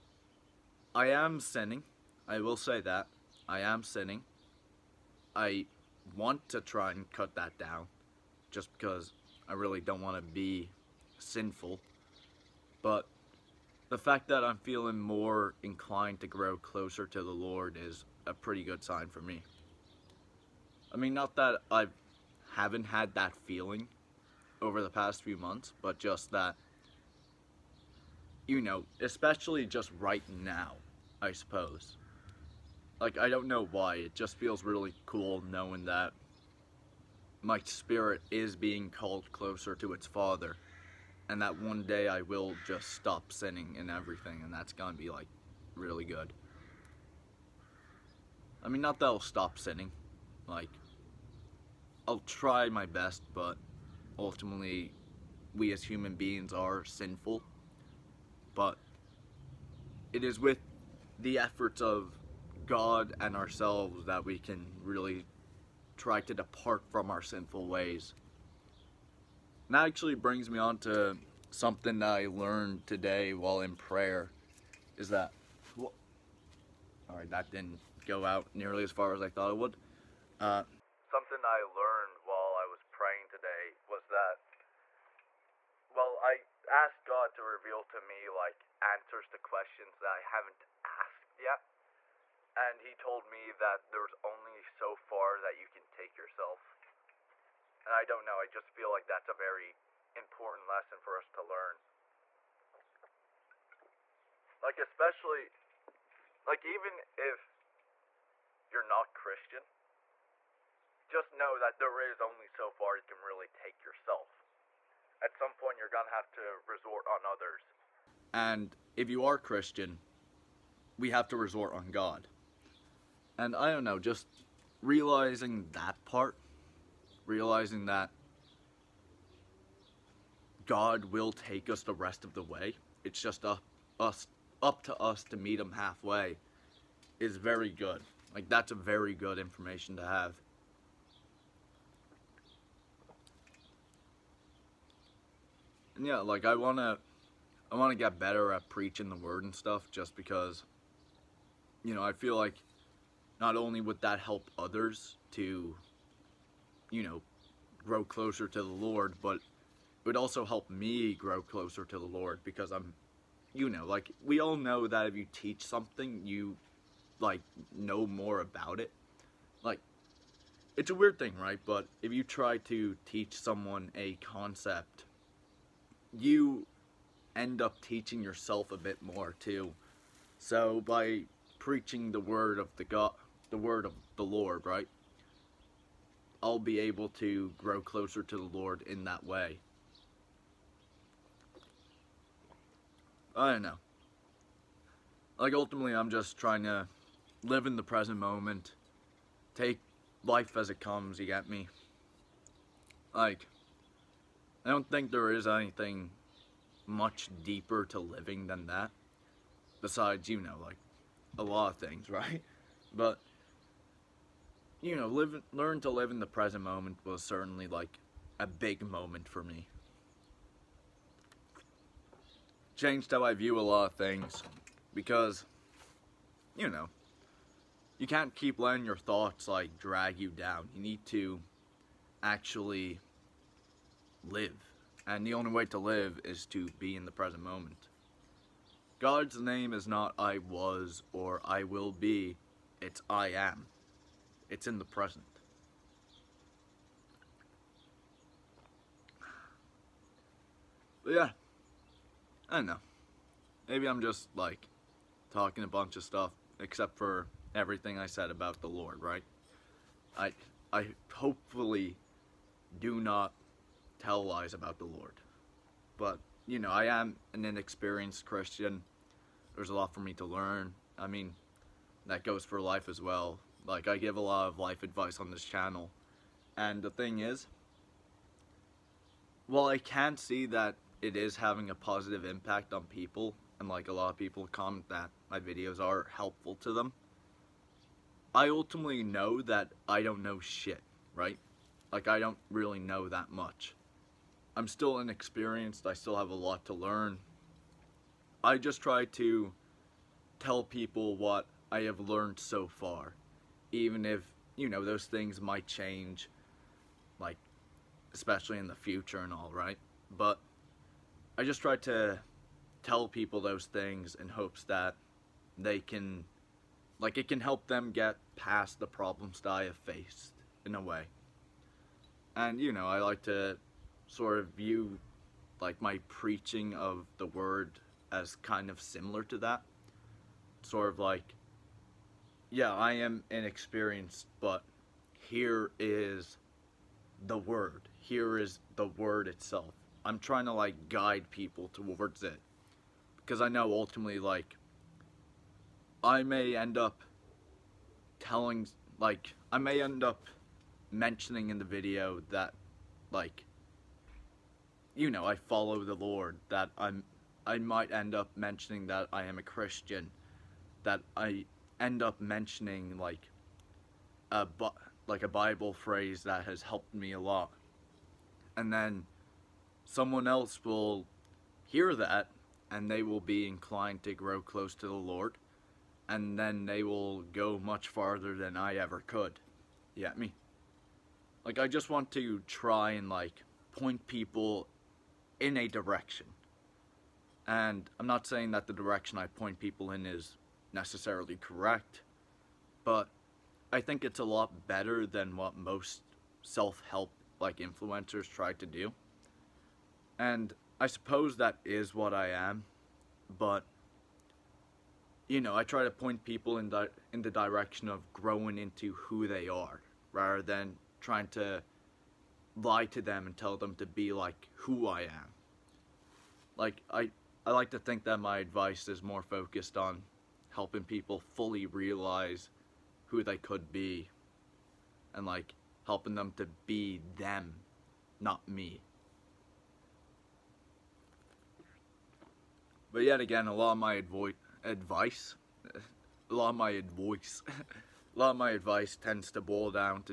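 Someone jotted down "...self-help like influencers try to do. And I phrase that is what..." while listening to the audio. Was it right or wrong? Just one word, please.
wrong.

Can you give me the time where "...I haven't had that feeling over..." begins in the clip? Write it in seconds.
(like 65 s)
21 s.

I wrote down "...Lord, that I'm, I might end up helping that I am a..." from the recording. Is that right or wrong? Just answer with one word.
wrong.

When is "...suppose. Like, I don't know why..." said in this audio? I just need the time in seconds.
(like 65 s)
31 s.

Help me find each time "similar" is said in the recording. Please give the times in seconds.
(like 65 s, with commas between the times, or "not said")
328 s.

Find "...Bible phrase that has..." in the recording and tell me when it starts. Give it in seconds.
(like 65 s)
365 s.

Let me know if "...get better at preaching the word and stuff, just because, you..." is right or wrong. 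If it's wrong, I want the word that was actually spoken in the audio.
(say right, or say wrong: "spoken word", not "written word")
right.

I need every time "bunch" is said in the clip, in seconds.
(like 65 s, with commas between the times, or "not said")
255 s.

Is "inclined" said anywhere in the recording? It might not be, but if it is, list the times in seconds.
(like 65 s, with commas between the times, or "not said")
15 s, 373 s.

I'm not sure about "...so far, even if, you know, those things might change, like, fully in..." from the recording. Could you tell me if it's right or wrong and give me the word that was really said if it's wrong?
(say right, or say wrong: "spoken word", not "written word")
wrong: "especially", not "fully".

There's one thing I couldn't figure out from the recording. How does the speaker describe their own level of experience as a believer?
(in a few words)
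inexperienced Christian.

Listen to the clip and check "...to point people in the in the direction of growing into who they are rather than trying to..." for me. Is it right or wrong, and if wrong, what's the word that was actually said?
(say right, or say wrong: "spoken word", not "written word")
right.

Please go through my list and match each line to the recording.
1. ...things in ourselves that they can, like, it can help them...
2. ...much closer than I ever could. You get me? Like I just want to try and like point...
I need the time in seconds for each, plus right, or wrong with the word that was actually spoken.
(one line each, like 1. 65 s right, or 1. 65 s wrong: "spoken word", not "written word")
1. 313 s wrong: "hopes", not "ourselves"
2. 377 s wrong: "farther", not "closer".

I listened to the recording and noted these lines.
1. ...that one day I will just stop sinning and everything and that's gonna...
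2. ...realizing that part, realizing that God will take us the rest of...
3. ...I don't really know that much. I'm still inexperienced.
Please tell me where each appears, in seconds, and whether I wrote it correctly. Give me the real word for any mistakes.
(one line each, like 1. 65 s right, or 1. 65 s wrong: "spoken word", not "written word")
1. 41 s right
2. 124 s right
3. 292 s right.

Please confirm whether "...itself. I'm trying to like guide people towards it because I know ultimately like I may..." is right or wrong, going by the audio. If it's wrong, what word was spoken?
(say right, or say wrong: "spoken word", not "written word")
right.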